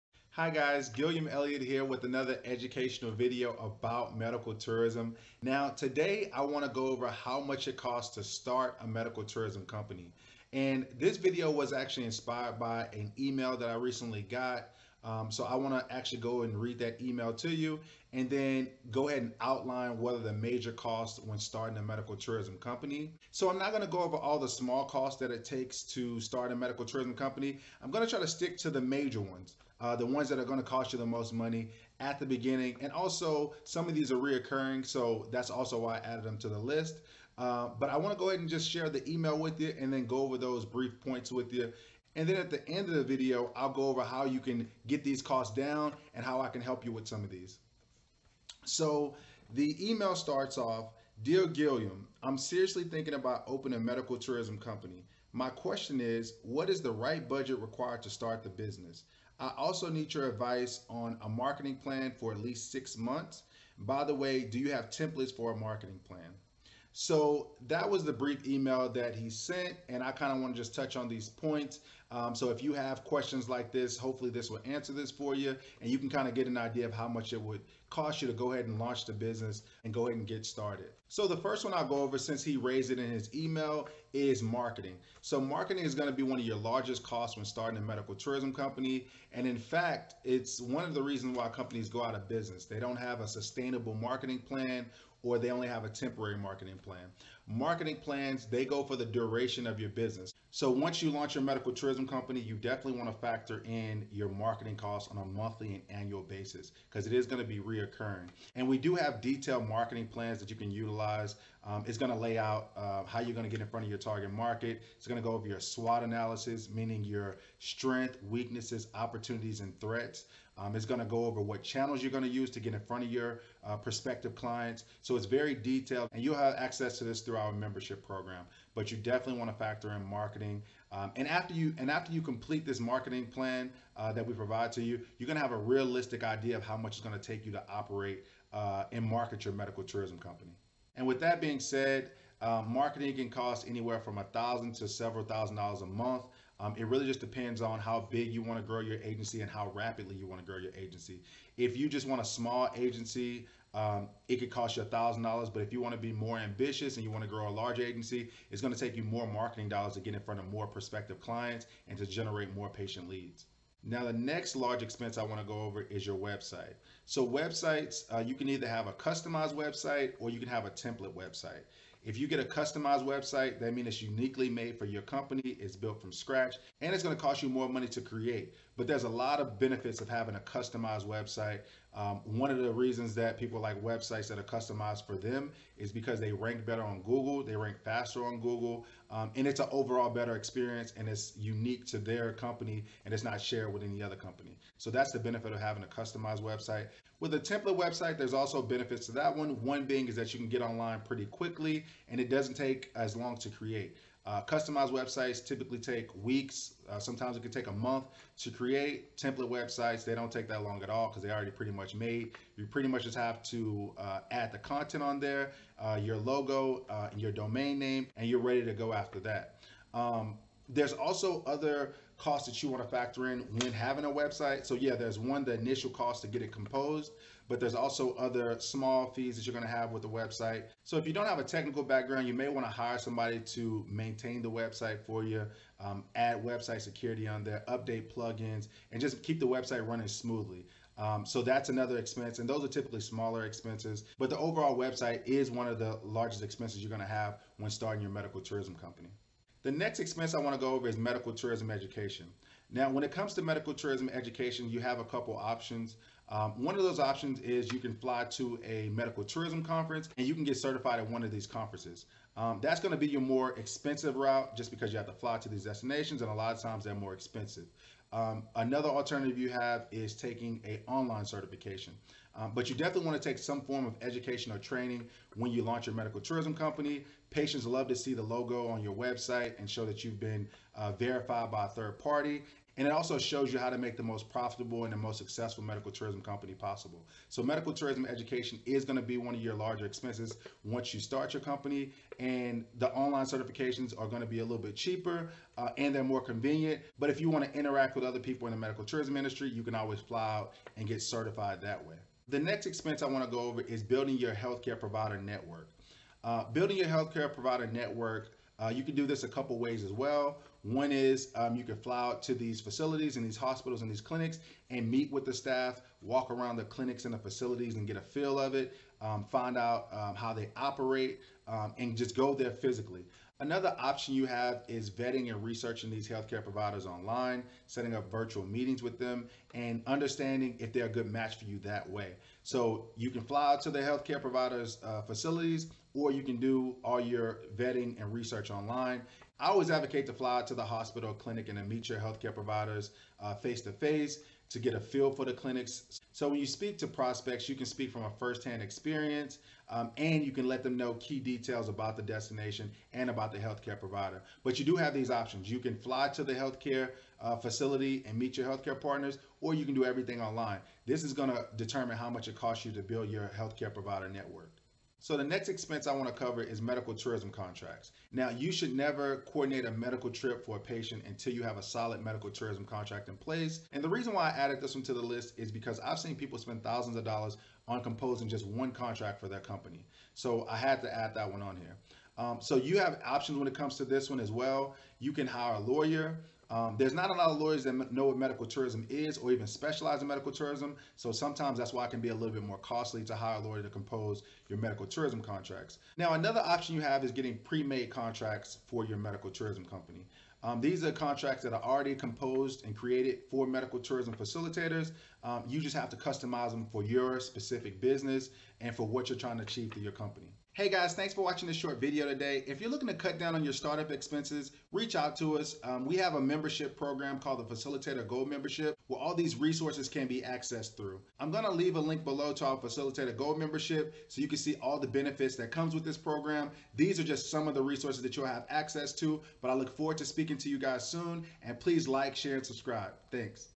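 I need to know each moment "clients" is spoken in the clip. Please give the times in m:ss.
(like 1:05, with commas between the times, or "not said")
2:04, 2:41.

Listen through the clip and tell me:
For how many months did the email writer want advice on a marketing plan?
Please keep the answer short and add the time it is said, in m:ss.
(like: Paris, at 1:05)
6, at 1:02.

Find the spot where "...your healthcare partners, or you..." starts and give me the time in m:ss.
5:58.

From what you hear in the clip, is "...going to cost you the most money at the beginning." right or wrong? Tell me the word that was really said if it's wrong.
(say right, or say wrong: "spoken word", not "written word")
right.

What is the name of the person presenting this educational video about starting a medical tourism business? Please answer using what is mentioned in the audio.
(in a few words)
Gilliam Elliott.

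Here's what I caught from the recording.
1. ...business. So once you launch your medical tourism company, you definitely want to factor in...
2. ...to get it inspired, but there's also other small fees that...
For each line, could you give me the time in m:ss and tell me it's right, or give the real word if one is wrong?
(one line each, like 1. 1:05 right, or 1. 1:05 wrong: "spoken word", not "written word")
1. 1:39 right
2. 3:46 wrong: "composed", not "inspired".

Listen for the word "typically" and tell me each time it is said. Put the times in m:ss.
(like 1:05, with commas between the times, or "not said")
3:25, 4:02.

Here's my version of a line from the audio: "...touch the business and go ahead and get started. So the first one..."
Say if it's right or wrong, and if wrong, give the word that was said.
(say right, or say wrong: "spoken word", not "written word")
wrong: "launch", not "touch".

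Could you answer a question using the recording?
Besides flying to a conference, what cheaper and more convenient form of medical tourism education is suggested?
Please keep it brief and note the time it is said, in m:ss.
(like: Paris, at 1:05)
online certification, at 4:30.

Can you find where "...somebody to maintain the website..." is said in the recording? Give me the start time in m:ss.
3:52.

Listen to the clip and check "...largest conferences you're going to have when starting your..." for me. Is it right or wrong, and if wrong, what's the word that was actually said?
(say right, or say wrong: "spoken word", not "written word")
wrong: "expenses", not "conferences".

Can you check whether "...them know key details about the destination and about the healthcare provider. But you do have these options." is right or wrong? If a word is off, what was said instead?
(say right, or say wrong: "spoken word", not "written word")
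right.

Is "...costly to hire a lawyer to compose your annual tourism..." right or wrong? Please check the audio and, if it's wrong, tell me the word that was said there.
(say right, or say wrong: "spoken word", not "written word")
wrong: "medical", not "annual".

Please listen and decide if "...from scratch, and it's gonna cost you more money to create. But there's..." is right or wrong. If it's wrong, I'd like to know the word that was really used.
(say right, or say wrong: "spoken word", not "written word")
right.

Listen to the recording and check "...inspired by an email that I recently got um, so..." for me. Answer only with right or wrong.
right.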